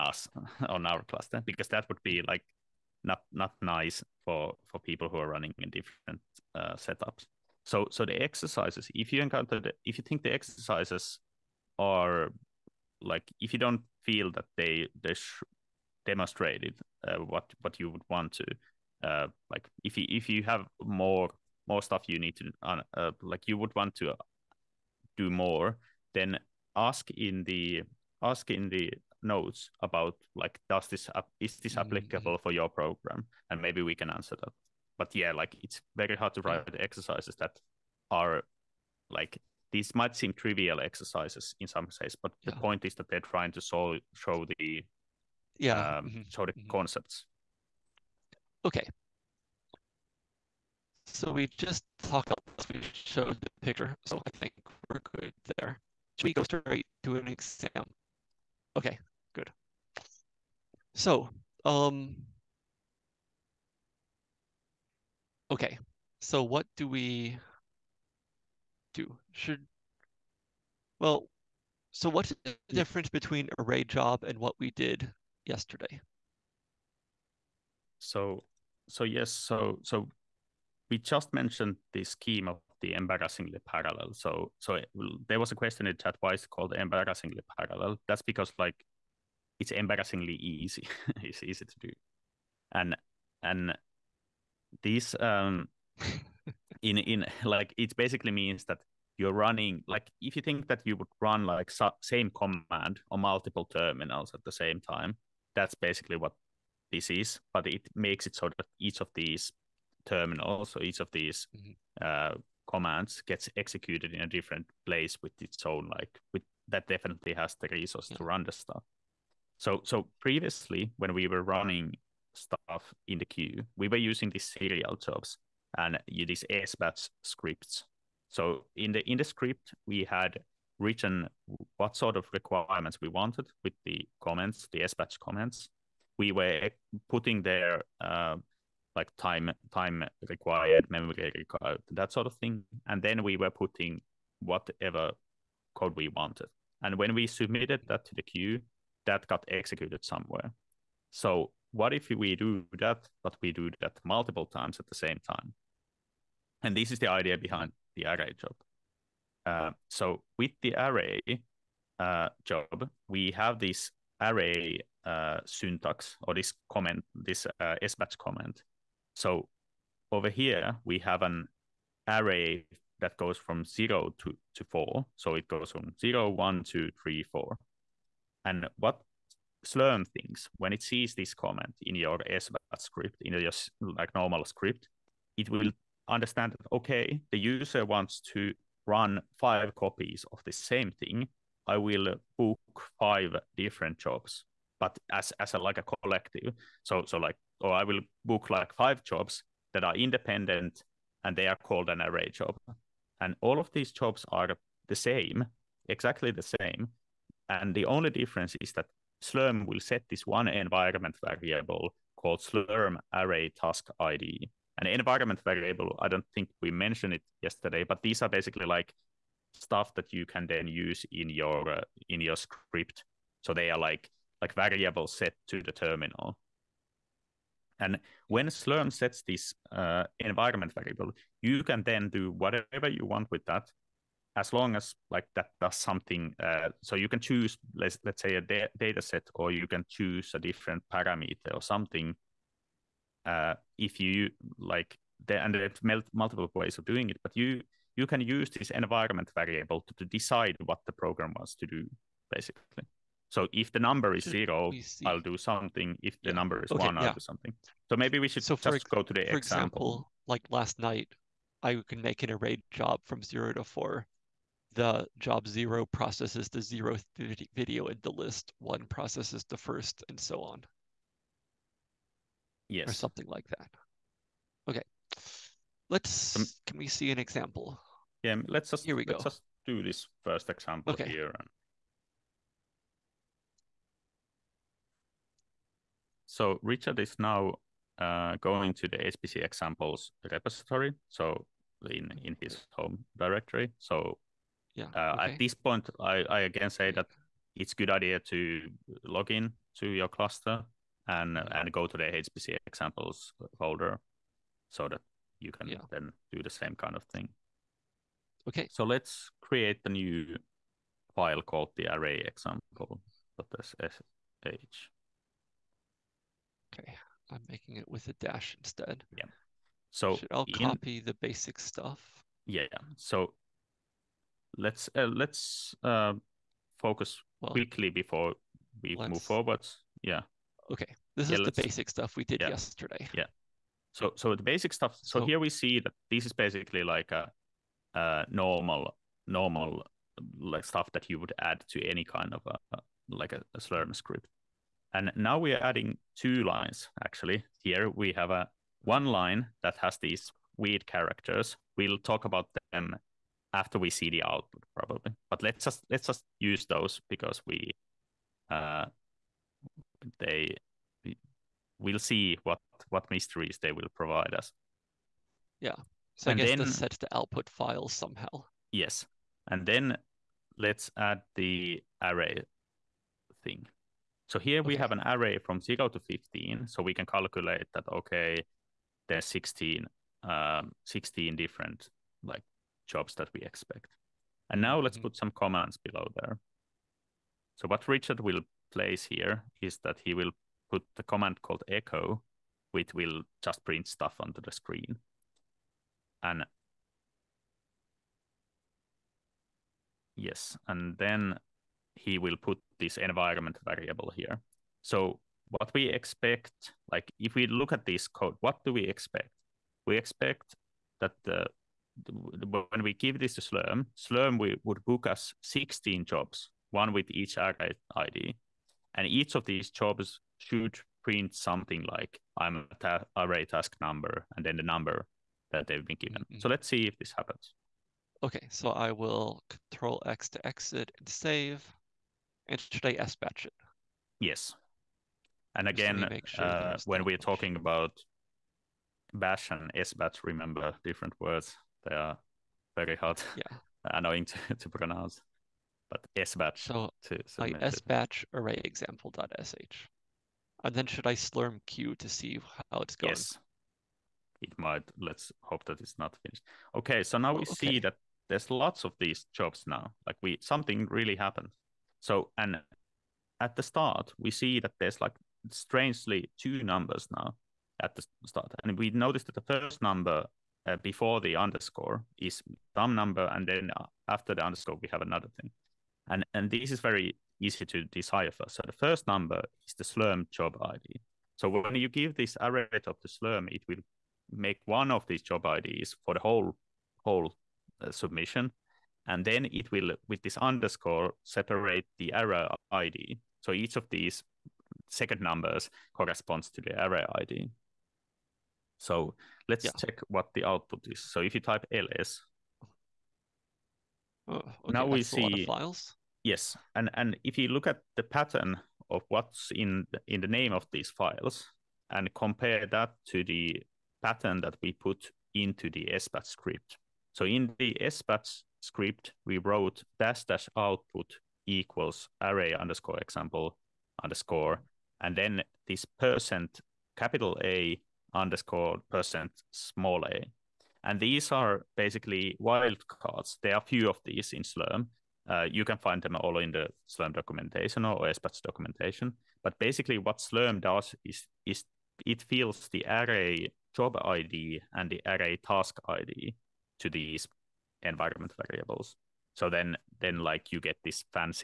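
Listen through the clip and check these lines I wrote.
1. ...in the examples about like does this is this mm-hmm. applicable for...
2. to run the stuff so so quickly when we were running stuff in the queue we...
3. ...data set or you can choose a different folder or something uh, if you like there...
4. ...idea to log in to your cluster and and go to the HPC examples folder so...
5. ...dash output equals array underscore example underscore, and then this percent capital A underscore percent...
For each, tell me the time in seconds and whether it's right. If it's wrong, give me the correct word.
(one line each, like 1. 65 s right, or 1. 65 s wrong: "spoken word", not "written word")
1. 28 s wrong: "notes", not "examples"
2. 118 s wrong: "previously", not "quickly"
3. 238 s wrong: "parameter", not "folder"
4. 297 s right
5. 520 s right.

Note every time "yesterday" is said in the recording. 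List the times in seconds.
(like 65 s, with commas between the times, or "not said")
75 s, 217 s, 332 s.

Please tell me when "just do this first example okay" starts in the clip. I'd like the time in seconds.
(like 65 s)
279 s.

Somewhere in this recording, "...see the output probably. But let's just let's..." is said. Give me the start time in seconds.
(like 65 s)
353 s.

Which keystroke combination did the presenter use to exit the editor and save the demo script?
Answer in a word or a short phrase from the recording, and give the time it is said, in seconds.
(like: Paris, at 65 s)
Control X, at 429 s.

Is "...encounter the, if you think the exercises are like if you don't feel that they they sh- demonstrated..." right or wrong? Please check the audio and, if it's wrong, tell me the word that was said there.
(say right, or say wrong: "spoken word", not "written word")
right.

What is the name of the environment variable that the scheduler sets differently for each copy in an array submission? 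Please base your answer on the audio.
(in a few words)
Slurm array task ID.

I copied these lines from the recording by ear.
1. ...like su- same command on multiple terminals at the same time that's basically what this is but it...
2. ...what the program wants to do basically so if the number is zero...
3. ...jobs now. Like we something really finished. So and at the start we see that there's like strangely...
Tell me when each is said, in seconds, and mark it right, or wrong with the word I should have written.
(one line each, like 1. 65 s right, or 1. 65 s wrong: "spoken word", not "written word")
1. 101 s right
2. 250 s right
3. 459 s wrong: "happened", not "finished".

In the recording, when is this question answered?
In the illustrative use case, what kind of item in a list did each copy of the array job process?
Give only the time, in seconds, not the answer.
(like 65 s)
267 s.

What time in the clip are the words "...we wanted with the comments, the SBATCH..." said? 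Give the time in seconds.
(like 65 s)
133 s.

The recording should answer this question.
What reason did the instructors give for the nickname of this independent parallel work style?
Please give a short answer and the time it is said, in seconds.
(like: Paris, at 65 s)
embarrassingly easy, at 89 s.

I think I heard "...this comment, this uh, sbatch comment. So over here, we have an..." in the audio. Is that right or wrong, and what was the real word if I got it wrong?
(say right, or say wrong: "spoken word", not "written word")
right.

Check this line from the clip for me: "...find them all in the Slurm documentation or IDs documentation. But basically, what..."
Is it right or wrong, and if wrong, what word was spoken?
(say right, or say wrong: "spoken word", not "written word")
wrong: "SBATCH", not "IDs".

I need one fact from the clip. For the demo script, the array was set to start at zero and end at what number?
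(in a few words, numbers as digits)
15.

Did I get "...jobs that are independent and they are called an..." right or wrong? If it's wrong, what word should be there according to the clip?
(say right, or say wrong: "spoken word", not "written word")
right.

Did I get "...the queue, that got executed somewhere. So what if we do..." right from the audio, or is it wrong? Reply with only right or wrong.
right.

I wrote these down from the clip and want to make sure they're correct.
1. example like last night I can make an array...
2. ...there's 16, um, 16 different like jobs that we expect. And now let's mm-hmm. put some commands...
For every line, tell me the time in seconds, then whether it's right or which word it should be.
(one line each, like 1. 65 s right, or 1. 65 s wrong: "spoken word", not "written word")
1. 259 s right
2. 379 s right.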